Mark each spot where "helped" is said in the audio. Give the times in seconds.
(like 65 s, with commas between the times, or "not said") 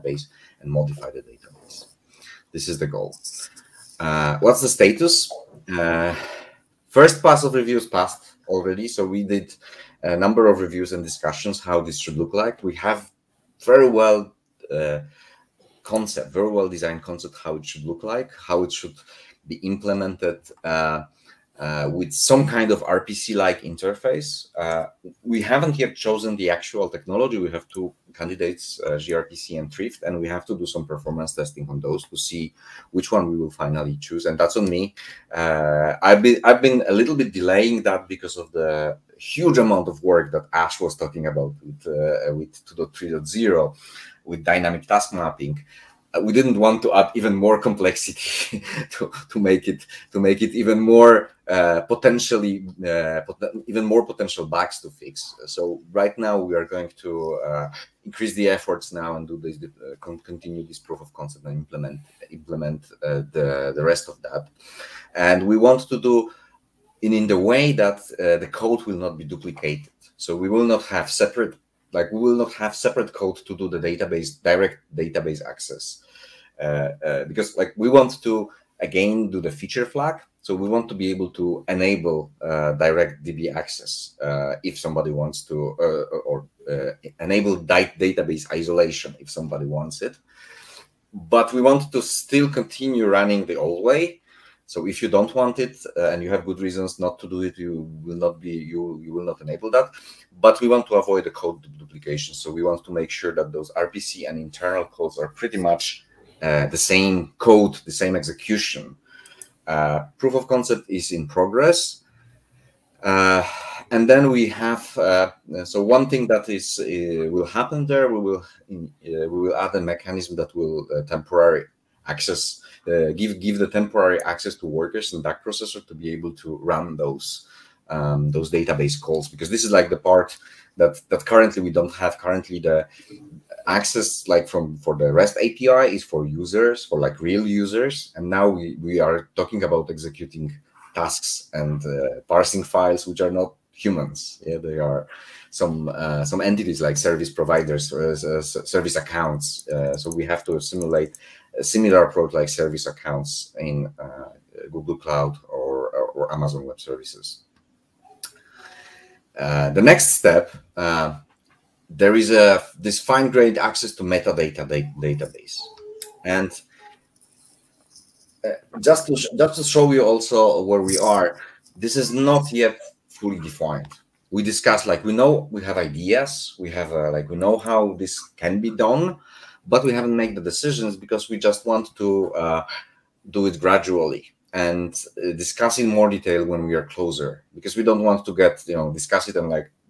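not said.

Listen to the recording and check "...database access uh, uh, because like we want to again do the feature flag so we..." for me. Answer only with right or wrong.
right.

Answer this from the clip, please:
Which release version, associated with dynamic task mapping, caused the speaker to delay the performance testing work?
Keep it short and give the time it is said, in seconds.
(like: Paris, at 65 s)
2.3.0, at 42 s.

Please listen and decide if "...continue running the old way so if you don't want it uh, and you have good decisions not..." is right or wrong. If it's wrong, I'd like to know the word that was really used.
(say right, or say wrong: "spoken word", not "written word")
wrong: "reasons", not "decisions".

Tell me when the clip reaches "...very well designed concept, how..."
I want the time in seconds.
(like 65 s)
16 s.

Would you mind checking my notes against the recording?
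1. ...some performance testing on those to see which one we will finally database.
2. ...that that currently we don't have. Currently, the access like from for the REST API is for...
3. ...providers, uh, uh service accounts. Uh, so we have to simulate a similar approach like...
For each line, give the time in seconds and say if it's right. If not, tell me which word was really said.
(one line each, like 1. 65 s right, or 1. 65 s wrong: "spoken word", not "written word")
1. 30 s wrong: "choose", not "database"
2. 130 s right
3. 147 s right.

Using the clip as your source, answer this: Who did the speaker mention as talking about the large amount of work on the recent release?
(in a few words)
Ash.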